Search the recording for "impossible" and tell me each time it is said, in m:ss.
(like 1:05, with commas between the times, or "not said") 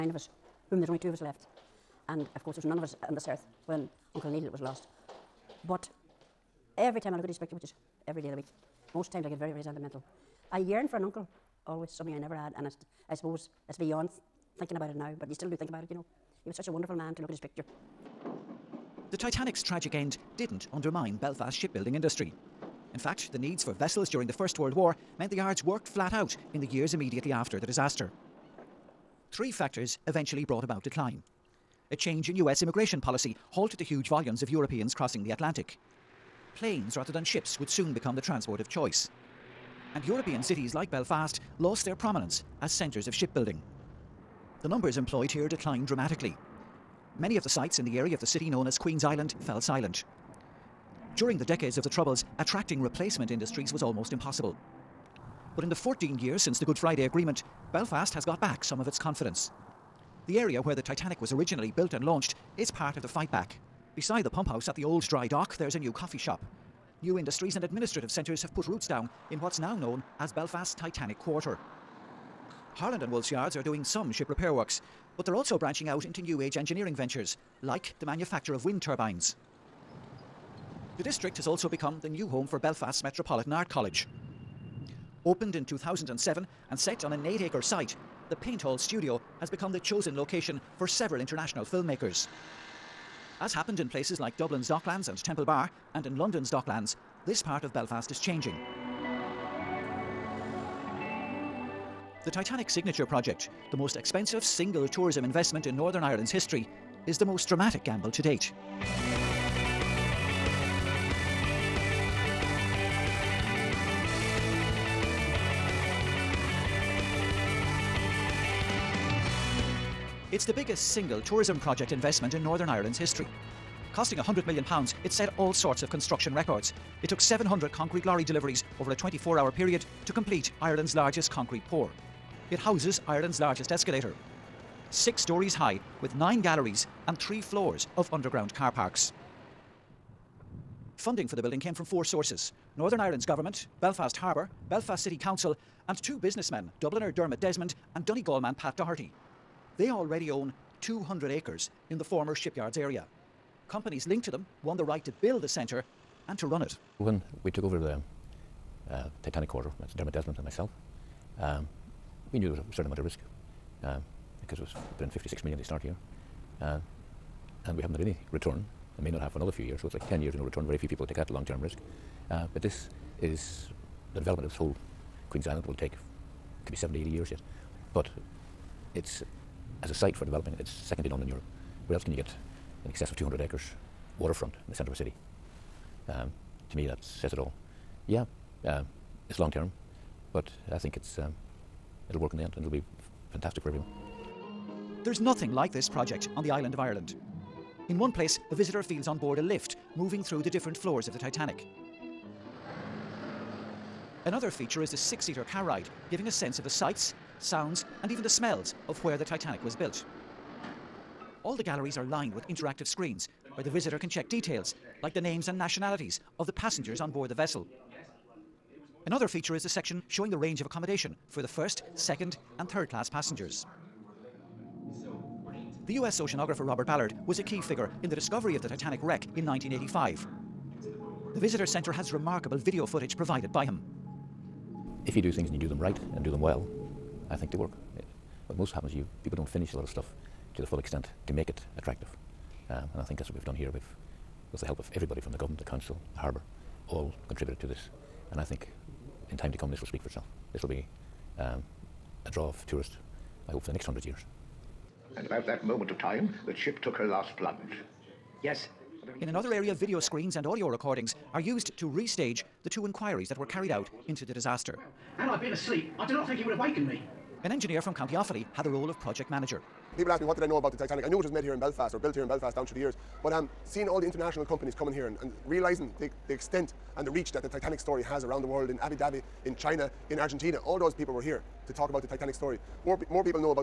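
0:54.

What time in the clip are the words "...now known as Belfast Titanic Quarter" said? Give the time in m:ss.
1:09.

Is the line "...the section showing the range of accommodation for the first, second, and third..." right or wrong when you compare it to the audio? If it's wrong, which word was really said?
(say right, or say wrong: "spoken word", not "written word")
right.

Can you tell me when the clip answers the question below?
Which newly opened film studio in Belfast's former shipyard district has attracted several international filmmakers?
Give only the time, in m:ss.
1:28.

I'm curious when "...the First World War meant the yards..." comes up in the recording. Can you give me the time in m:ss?
0:24.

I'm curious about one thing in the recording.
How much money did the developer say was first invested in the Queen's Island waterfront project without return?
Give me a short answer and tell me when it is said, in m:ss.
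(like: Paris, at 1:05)
56 million, at 2:45.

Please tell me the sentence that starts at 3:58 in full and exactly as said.
What most happens, you people don't finish a lot of stuff to the full extent to make it attractive.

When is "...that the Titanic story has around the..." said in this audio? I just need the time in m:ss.
4:37.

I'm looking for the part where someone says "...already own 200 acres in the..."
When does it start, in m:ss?
2:29.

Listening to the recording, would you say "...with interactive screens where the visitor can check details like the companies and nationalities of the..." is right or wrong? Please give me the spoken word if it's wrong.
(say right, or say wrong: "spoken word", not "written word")
wrong: "names", not "companies".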